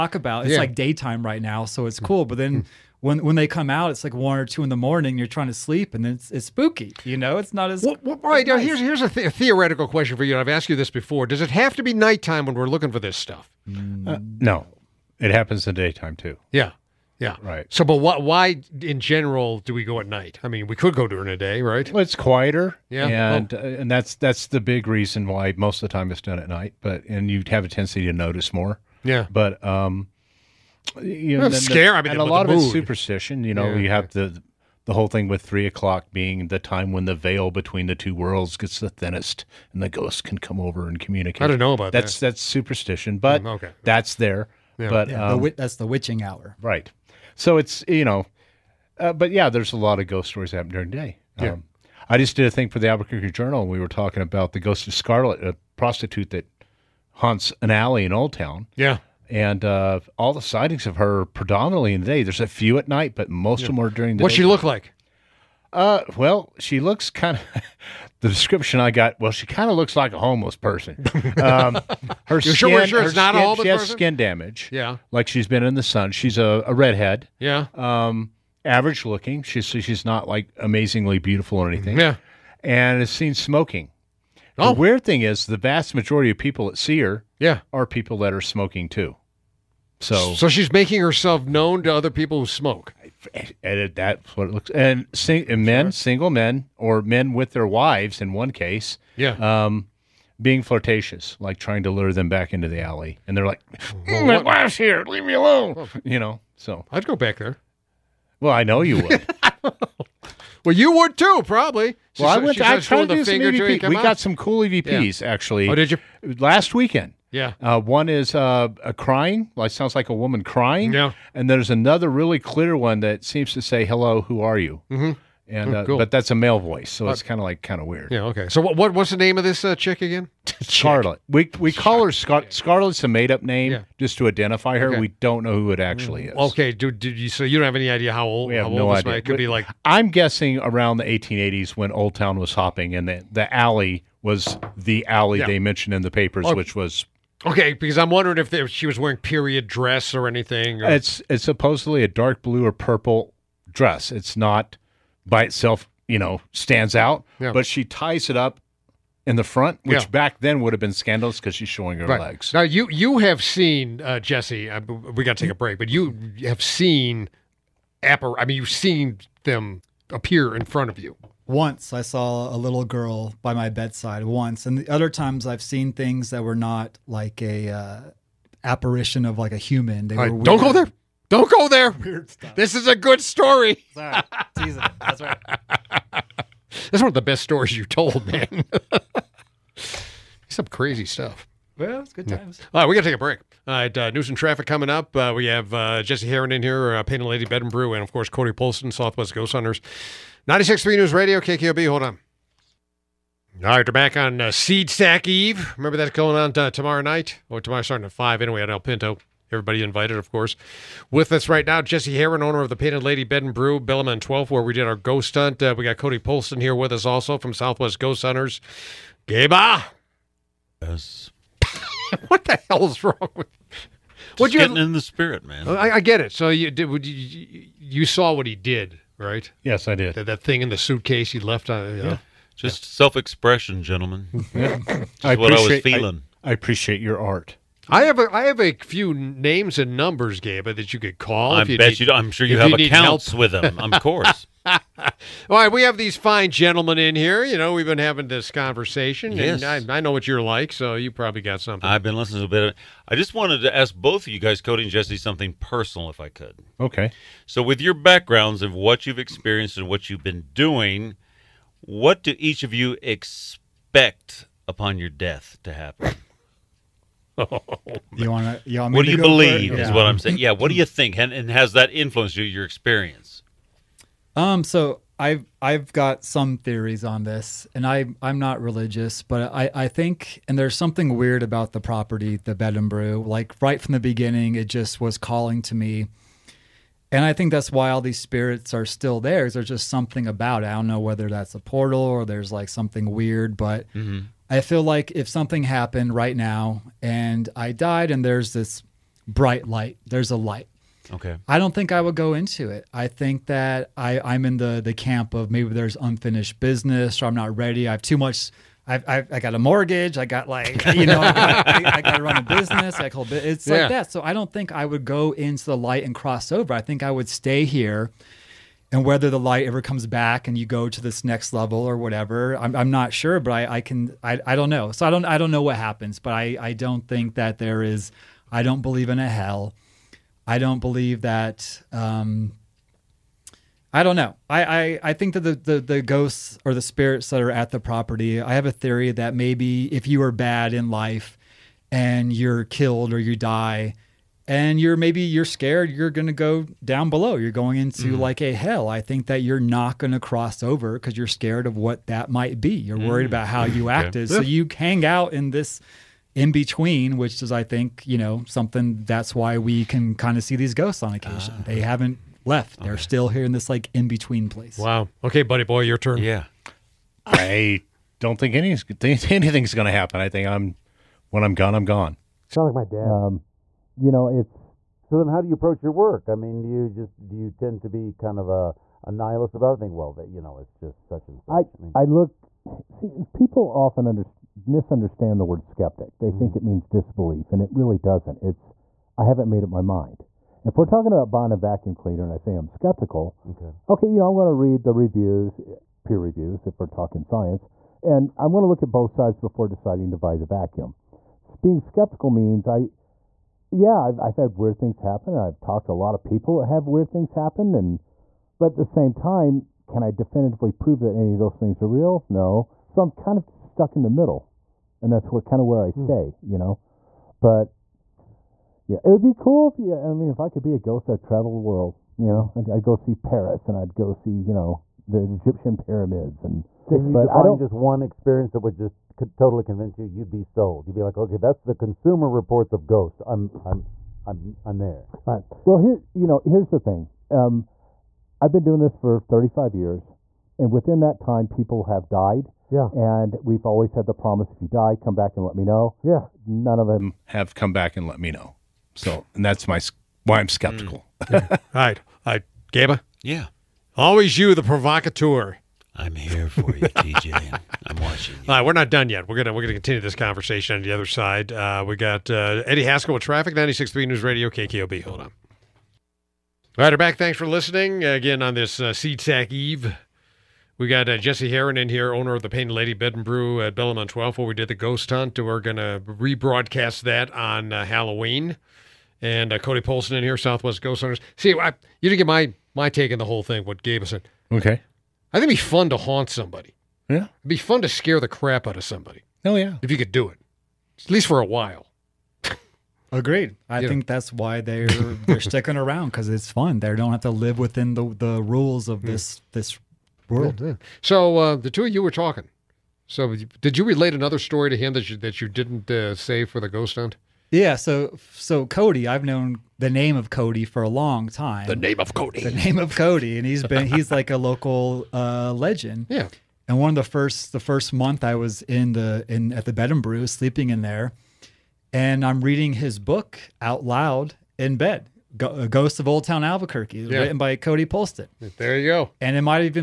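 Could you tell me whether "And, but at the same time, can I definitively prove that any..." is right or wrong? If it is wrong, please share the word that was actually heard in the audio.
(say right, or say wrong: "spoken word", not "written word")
right.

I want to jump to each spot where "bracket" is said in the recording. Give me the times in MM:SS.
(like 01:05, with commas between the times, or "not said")
not said.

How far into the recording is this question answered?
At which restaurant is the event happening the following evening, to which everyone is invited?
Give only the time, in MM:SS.
03:28.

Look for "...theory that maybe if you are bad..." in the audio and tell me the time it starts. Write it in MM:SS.
05:38.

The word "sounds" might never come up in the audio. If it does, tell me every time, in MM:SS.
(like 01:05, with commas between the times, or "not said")
01:59, 06:12.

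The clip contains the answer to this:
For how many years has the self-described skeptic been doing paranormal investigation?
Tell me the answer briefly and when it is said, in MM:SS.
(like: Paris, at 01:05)
35, at 07:19.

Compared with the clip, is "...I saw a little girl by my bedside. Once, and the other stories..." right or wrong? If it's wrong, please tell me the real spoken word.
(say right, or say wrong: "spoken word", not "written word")
wrong: "times", not "stories".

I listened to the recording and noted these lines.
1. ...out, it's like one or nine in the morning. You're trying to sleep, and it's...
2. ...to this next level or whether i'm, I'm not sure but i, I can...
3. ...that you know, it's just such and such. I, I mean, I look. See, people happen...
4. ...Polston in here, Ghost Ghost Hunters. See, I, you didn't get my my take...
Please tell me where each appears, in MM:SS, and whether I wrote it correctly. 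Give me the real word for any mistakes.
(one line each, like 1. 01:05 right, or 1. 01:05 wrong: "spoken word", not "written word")
1. 00:03 wrong: "two", not "nine"
2. 05:20 wrong: "whatever", not "whether"
3. 06:20 wrong: "often", not "happen"
4. 07:59 wrong: "Southwest", not "Ghost".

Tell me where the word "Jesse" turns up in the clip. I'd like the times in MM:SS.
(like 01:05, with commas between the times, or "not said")
02:44, 03:16, 03:31, 04:14, 07:51.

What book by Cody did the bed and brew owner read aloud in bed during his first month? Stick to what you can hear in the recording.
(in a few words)
Ghost of Old Town Albuquerque.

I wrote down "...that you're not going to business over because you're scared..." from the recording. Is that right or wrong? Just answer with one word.
wrong.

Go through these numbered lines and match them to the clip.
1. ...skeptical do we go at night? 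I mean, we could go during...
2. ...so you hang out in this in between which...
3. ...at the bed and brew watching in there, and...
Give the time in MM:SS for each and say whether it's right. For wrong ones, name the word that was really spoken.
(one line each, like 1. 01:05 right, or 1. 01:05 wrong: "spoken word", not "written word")
1. 00:18 wrong: "general", not "skeptical"
2. 05:54 right
3. 08:39 wrong: "sleeping", not "watching".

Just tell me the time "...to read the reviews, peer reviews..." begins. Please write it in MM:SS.
06:34.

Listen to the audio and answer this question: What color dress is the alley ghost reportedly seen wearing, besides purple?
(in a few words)
dark blue.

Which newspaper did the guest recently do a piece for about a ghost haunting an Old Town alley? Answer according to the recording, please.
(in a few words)
Albuquerque Journal.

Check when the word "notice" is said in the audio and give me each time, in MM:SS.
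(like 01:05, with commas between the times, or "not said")
00:28.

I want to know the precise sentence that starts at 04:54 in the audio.
I feel like if something happened right now and I died and there's this bright light, there's a light.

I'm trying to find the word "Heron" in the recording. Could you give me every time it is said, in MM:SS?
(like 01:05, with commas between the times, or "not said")
03:16, 03:32, 07:51.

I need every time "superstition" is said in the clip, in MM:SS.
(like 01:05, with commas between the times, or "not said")
00:32, 00:42.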